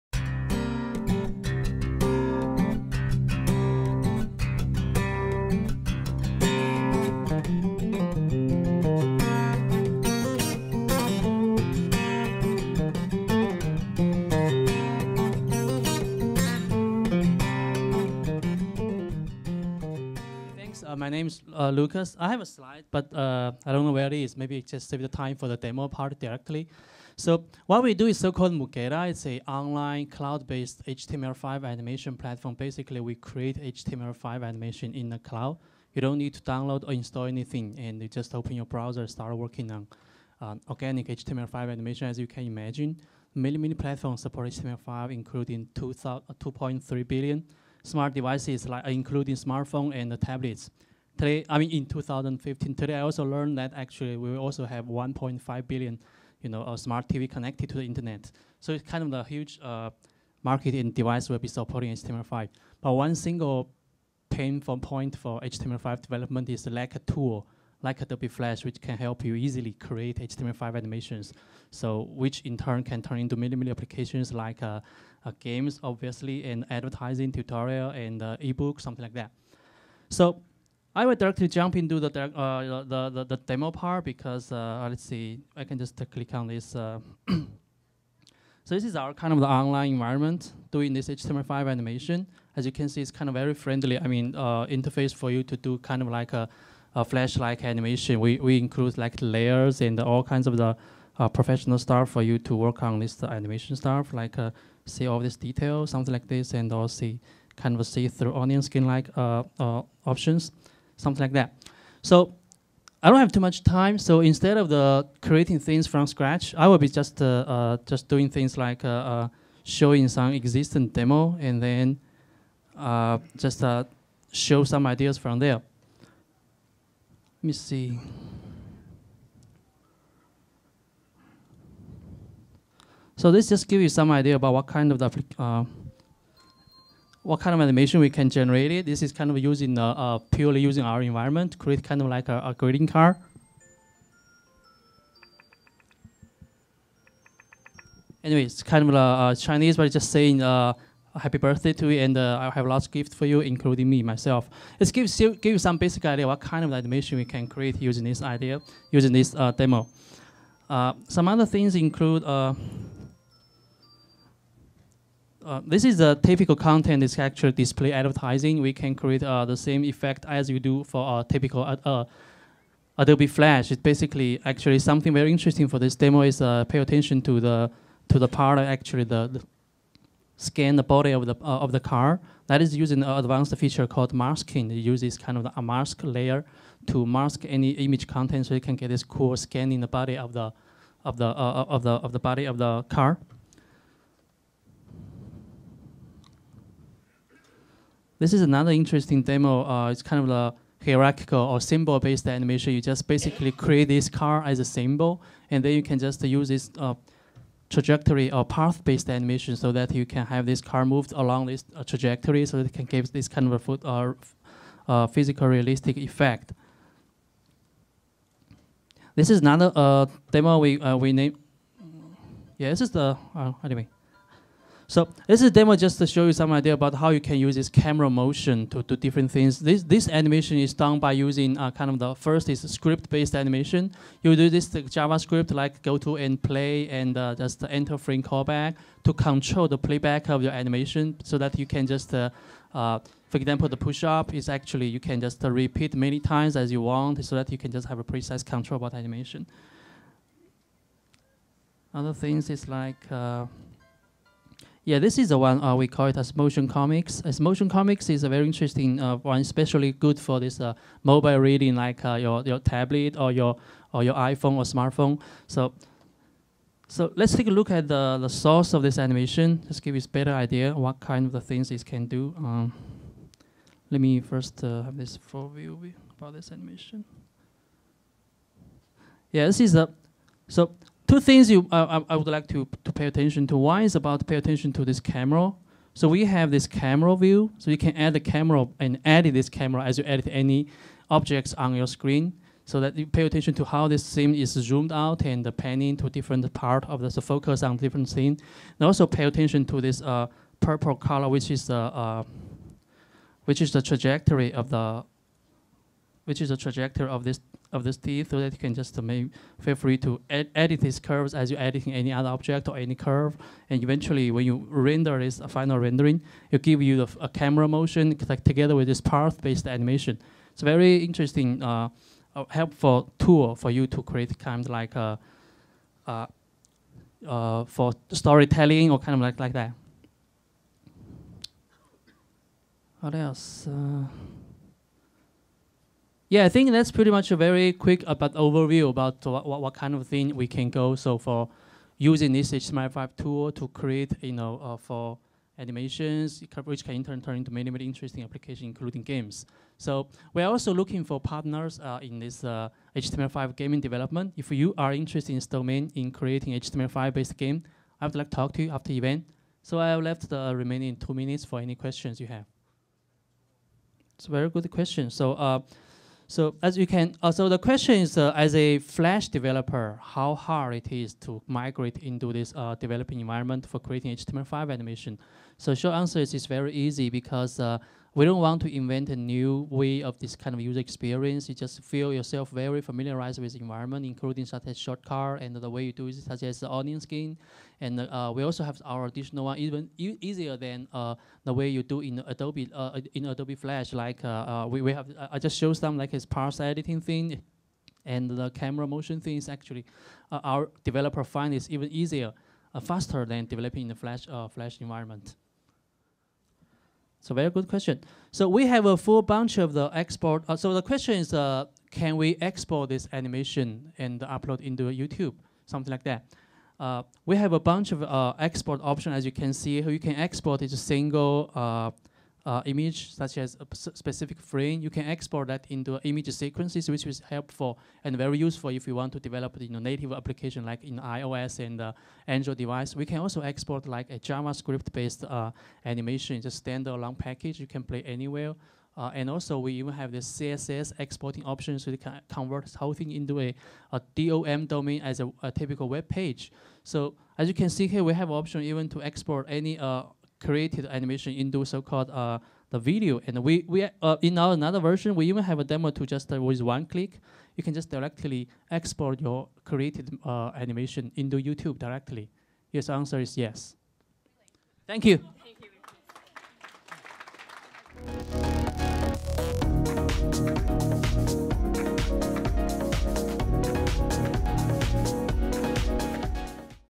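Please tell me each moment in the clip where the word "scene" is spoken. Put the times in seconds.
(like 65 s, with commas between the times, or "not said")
294 s, 298 s.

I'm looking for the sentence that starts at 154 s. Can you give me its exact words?
Let's give, give you some basic idea what kind of animation we can create using this idea, using this uh, demo.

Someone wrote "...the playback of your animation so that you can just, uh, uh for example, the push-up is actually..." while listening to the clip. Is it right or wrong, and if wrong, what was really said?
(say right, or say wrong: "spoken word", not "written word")
right.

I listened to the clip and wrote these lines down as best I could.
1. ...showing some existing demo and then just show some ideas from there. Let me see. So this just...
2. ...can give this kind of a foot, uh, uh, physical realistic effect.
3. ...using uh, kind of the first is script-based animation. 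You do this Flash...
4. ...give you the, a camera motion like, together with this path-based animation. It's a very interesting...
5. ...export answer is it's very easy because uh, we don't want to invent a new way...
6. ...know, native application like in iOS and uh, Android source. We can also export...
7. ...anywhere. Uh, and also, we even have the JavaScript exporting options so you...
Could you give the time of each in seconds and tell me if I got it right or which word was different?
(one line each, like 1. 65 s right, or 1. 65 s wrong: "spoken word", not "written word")
1. 119 s right
2. 212 s right
3. 231 s wrong: "JavaScript", not "Flash"
4. 316 s right
5. 375 s wrong: "short", not "export"
6. 429 s wrong: "device", not "source"
7. 438 s wrong: "CSS", not "JavaScript".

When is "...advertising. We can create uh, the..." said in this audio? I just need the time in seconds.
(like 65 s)
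167 s.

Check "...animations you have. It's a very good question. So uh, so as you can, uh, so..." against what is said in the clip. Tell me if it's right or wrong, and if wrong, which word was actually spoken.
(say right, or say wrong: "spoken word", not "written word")
wrong: "questions", not "animations".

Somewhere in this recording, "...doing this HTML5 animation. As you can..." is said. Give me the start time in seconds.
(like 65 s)
90 s.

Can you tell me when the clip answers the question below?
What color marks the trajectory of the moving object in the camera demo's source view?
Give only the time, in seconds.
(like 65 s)
300 s.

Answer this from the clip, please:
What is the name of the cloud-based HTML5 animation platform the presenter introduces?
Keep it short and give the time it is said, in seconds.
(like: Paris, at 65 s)
Mugeda, at 28 s.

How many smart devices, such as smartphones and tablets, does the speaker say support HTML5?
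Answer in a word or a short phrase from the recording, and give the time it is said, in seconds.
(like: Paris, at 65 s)
2.3 billion, at 45 s.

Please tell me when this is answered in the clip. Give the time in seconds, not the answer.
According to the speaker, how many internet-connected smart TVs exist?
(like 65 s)
54 s.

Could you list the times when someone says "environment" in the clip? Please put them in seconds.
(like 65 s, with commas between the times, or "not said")
89 s, 141 s, 373 s, 383 s, 404 s.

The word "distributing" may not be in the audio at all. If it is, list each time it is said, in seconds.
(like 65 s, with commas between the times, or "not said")
not said.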